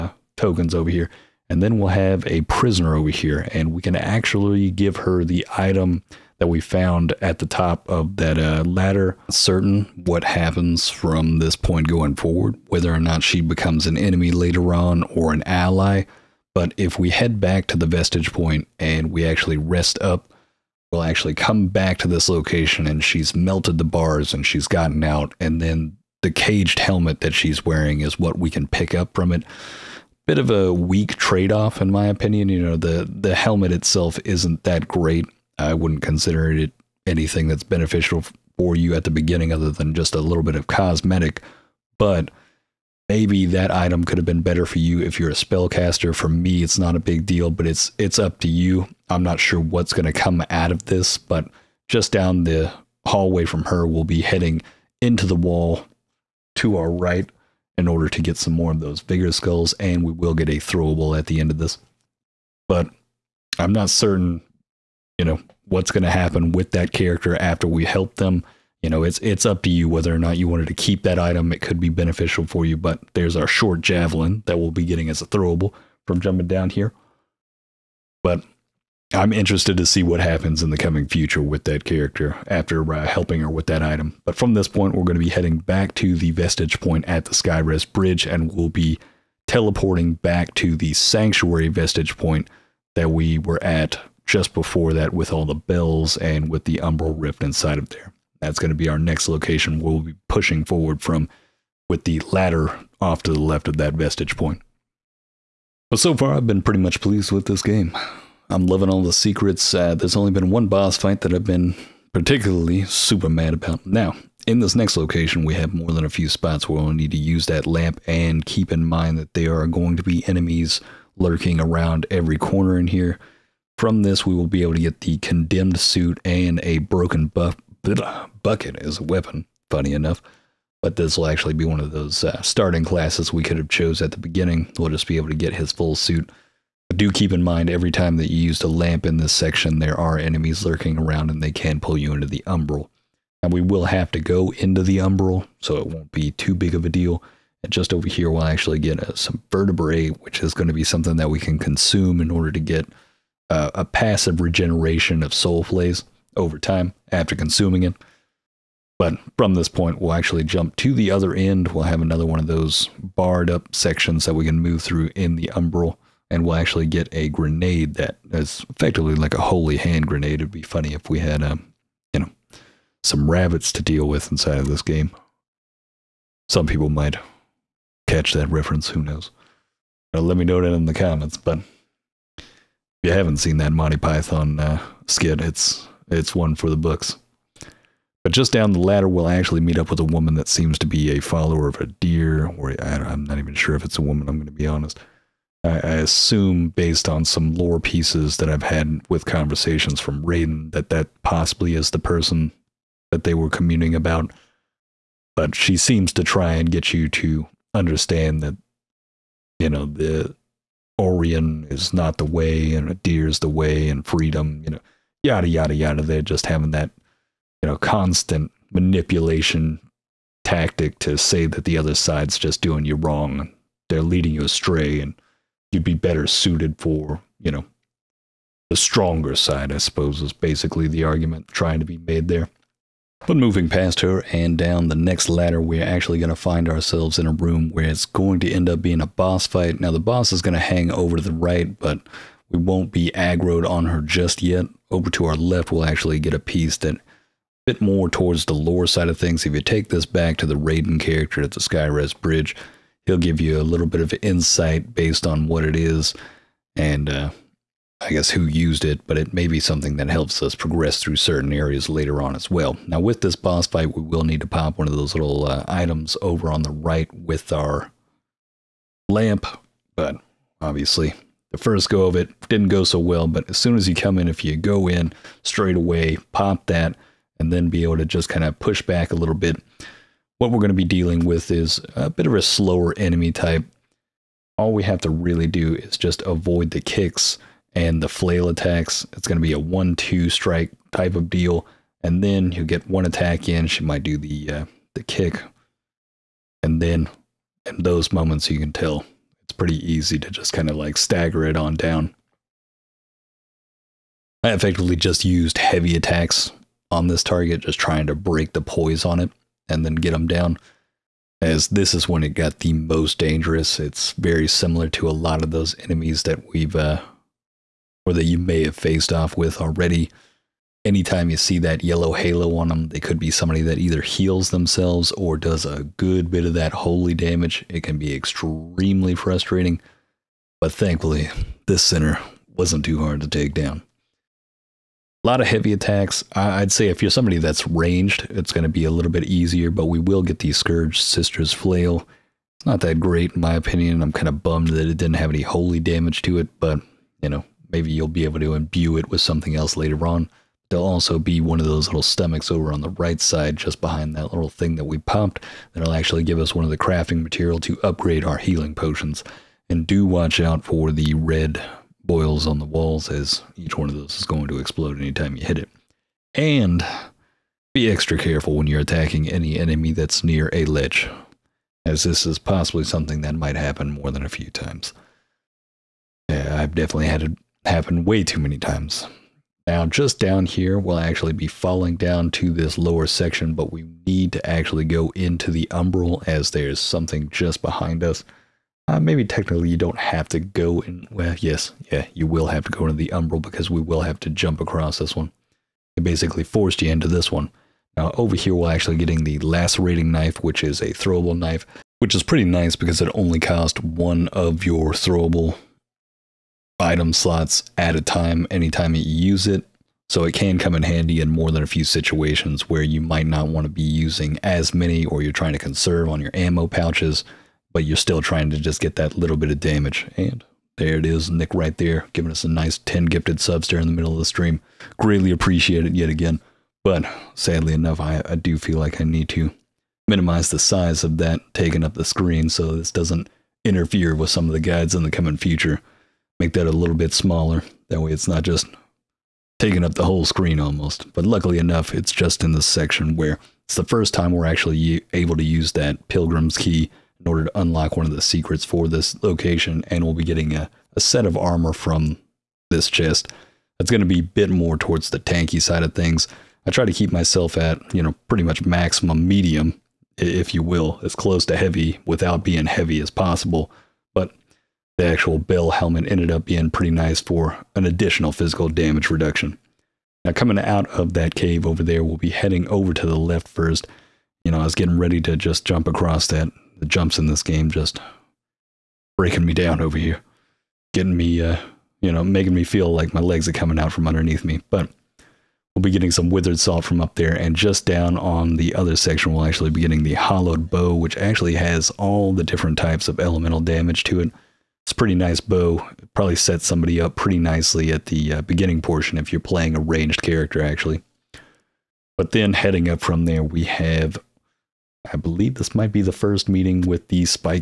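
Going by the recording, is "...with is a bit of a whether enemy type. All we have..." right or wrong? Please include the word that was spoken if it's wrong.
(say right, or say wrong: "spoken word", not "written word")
wrong: "slower", not "whether".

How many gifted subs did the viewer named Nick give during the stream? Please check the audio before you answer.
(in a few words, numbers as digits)
10.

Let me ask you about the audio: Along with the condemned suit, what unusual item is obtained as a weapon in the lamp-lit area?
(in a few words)
Broken buff bucket.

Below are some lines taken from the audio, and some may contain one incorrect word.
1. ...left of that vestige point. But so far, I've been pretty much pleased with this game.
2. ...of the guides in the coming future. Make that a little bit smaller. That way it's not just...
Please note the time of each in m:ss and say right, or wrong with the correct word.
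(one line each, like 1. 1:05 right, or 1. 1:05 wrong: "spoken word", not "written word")
1. 1:43 right
2. 7:14 right.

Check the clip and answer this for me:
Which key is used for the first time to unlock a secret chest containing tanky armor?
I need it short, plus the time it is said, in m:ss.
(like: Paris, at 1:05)
Pilgrim's Key, at 7:26.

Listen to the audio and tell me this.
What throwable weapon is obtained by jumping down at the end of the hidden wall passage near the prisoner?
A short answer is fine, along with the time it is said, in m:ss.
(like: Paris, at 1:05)
Short javelin, at 1:13.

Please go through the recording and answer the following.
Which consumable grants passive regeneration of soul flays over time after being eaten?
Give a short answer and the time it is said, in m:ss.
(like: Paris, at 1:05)
Vertebrae, at 2:29.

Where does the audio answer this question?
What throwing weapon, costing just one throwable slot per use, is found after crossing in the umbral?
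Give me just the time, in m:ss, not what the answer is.
6:39.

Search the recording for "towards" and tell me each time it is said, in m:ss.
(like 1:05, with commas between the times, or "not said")
4:08, 7:34.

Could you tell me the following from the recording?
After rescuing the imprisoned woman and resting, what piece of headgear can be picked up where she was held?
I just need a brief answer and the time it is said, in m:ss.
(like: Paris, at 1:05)
Caged helmet, at 0:26.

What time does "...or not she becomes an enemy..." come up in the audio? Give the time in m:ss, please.
0:12.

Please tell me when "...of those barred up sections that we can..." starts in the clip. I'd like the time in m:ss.
2:42.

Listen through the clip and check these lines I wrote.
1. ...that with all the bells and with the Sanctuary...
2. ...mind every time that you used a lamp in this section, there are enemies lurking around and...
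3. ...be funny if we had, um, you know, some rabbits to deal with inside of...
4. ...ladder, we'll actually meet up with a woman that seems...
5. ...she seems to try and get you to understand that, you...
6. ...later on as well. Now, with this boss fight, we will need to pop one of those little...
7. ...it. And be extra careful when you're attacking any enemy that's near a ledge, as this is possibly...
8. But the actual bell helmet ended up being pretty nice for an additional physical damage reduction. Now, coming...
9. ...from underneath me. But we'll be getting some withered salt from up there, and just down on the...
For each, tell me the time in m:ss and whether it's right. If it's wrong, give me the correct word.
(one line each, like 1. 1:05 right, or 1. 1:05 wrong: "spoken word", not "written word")
1. 1:34 wrong: "Umbral", not "Sanctuary"
2. 2:17 right
3. 2:50 right
4. 3:08 right
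5. 3:25 right
6. 4:21 right
7. 6:05 right
8. 7:44 right
9. 8:03 right.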